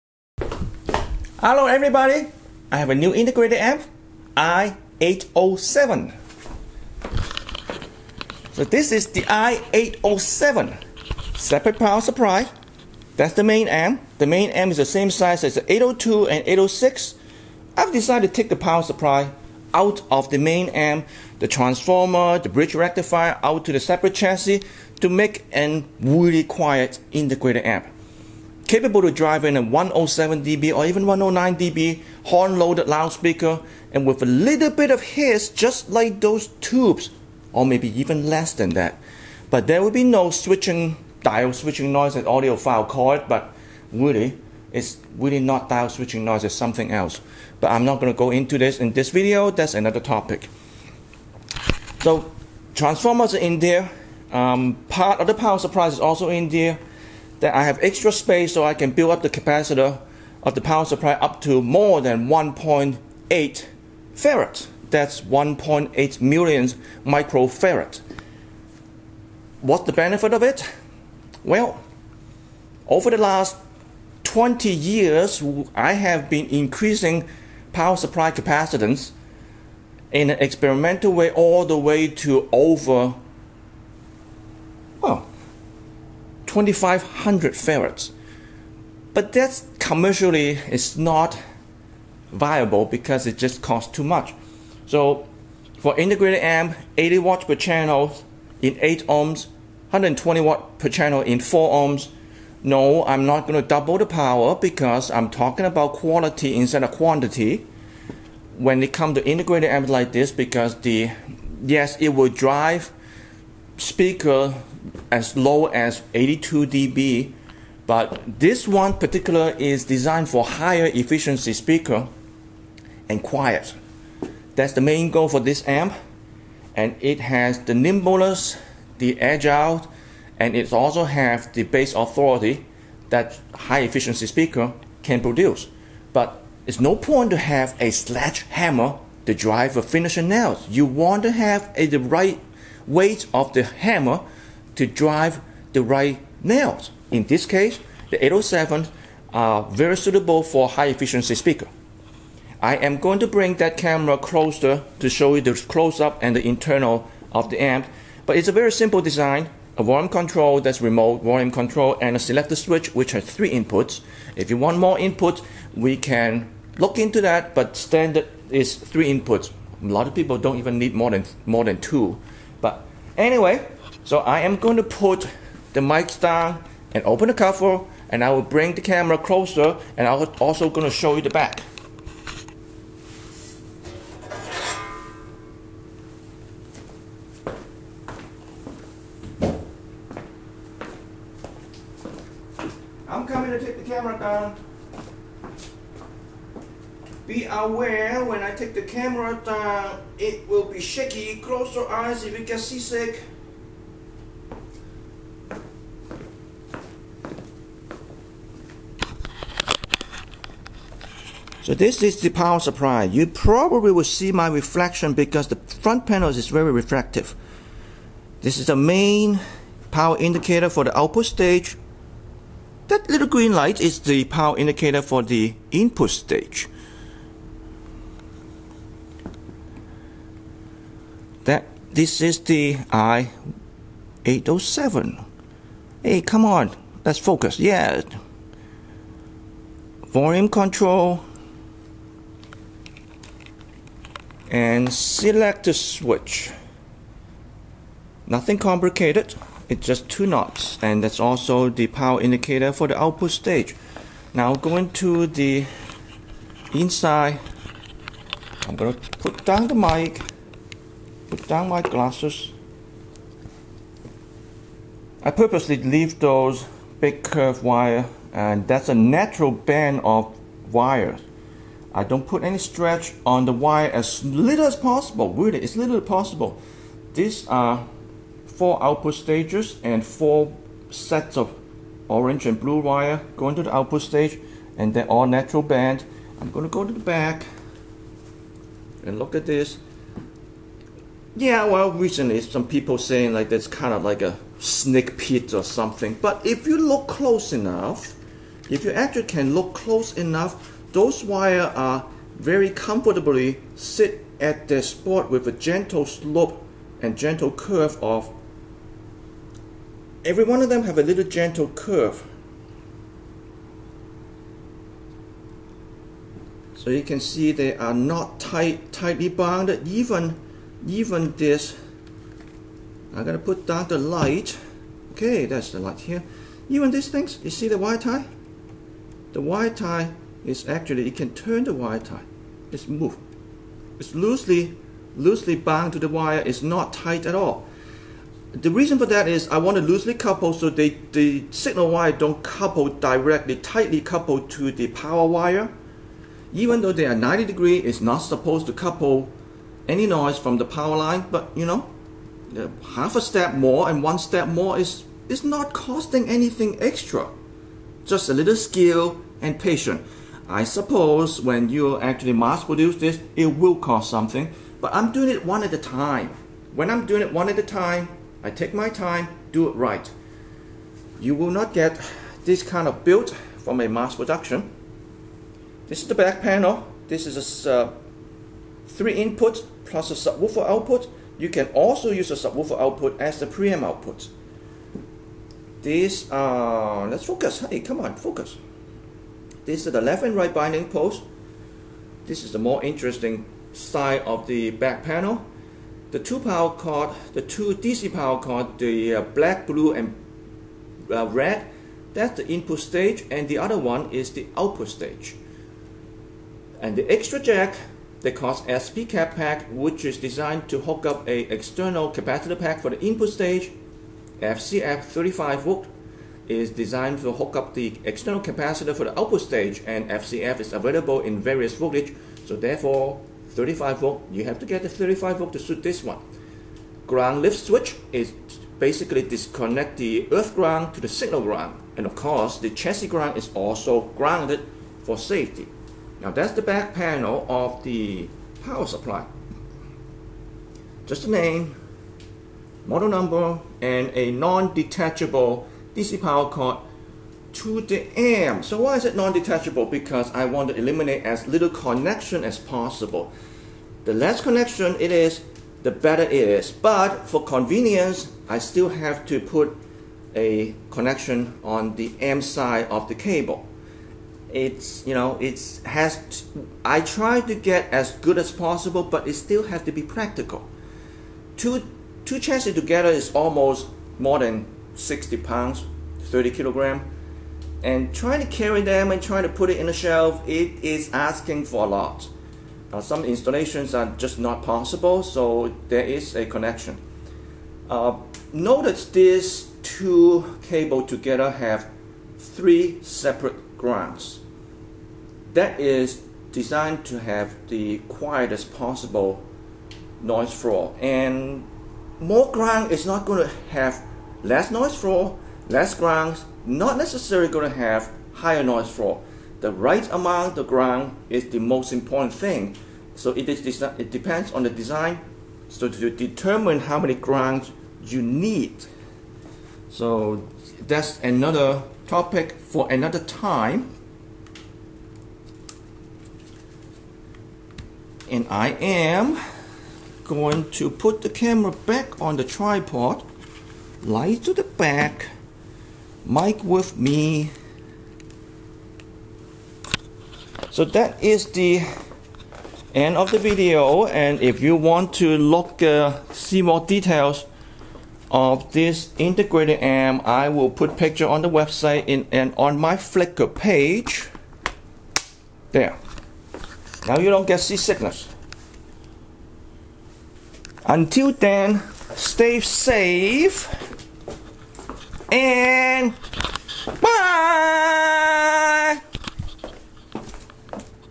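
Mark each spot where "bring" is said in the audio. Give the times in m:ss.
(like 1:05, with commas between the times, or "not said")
2:33, 2:58.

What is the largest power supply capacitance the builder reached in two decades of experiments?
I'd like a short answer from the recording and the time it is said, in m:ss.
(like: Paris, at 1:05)
2,500 farads, at 1:26.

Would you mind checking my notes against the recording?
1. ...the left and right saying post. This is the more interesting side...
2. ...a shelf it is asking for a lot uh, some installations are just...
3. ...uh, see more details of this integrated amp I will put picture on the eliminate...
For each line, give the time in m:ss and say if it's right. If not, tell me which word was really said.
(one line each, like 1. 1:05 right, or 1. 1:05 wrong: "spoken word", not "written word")
1. 6:29 wrong: "binding", not "saying"
2. 7:59 right
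3. 9:05 wrong: "website", not "eliminate".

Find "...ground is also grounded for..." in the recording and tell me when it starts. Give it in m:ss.
7:13.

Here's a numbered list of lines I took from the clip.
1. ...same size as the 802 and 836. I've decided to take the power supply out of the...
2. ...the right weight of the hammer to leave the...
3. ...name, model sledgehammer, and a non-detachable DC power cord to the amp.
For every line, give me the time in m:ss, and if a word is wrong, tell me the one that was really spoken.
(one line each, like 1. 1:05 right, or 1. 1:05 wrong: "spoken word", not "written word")
1. 0:14 wrong: "806", not "836"
2. 2:21 wrong: "drive", not "leave"
3. 7:21 wrong: "number", not "sledgehammer".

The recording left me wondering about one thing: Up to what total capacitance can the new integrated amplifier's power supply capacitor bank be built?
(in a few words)
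1.8 farad.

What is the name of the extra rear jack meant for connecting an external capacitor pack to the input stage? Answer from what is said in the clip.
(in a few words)
SP cap pack.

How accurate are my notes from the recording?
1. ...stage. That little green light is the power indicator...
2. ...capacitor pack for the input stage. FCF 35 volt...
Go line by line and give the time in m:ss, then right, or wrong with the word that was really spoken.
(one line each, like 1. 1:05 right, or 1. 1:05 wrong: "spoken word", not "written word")
1. 3:41 right
2. 6:52 right.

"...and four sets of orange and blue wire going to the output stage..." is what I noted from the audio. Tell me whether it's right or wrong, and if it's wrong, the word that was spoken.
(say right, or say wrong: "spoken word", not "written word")
right.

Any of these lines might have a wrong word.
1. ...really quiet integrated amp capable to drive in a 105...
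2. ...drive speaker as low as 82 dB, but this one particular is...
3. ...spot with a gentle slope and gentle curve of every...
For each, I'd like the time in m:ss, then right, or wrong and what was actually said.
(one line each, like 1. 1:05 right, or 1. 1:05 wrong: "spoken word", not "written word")
1. 0:26 wrong: "107", not "105"
2. 1:52 right
3. 5:04 right.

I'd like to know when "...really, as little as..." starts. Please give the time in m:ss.
4:35.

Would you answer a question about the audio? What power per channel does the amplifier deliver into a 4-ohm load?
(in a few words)
120 watt.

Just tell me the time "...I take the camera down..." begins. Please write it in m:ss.
3:18.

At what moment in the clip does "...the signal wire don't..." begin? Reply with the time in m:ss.
5:41.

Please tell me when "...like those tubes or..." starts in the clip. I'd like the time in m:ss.
0:35.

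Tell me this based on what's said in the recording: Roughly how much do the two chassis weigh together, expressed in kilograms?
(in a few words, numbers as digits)
30 kilogram.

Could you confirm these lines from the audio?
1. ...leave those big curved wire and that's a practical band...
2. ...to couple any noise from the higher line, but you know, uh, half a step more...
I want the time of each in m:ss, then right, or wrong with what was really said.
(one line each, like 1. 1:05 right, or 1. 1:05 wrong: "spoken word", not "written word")
1. 4:25 wrong: "natural", not "practical"
2. 5:48 wrong: "power", not "higher".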